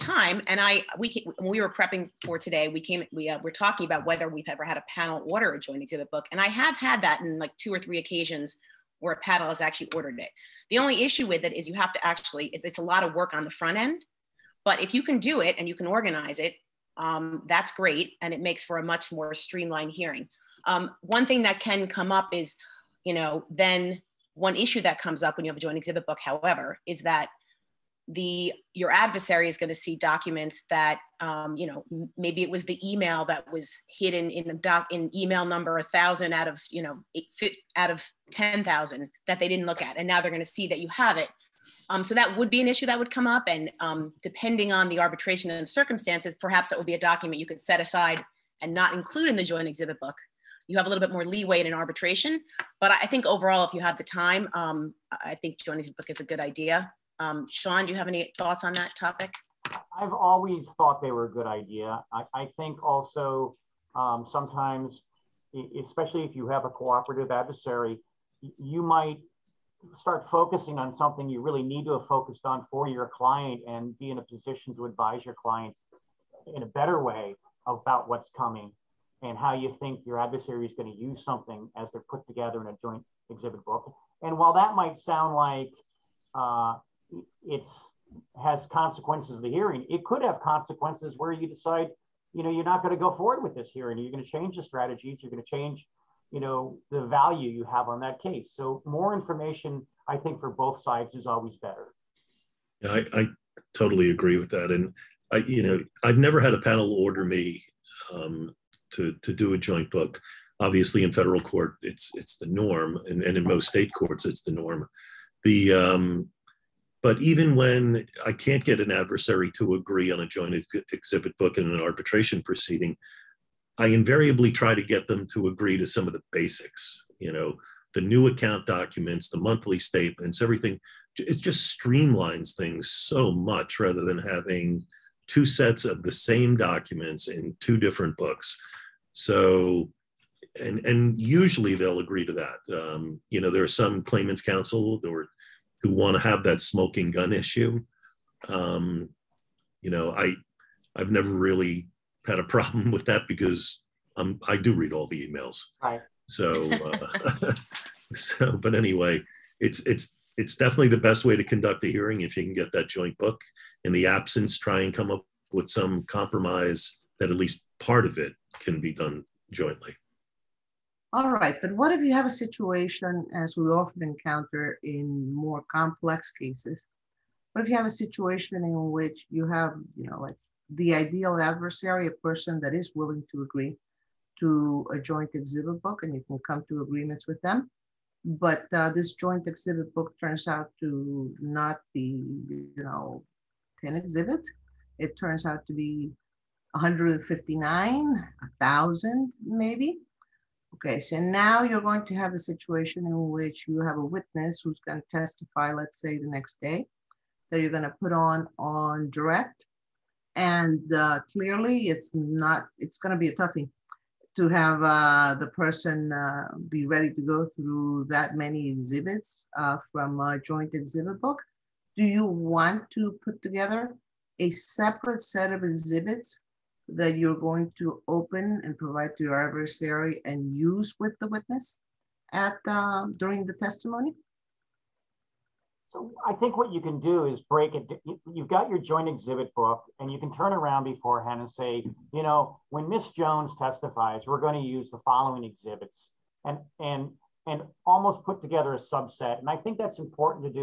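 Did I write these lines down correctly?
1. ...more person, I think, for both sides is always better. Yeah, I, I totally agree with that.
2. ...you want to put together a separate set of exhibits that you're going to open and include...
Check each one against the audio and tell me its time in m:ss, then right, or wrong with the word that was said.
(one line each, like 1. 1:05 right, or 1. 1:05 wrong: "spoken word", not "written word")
1. 1:38 wrong: "information", not "person"
2. 3:42 wrong: "provide", not "include".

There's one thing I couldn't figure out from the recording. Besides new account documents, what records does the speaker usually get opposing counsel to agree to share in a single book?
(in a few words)
monthly statements.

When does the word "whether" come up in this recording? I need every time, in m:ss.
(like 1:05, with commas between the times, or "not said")
0:04.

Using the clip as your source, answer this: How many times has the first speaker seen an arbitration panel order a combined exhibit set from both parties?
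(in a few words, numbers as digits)
2 or 3.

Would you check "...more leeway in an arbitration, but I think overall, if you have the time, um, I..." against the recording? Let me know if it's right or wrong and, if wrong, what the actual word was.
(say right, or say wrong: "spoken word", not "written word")
right.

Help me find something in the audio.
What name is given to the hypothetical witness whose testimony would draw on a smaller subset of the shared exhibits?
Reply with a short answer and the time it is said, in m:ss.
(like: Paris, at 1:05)
Miss Jones, at 4:02.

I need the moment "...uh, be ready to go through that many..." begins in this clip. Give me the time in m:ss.
3:36.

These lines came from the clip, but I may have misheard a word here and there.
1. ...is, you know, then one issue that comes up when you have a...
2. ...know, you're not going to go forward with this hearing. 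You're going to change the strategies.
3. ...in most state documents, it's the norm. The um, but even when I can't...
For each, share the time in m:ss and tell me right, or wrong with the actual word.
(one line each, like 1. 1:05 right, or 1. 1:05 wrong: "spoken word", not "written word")
1. 0:22 right
2. 1:32 right
3. 1:53 wrong: "courts", not "documents".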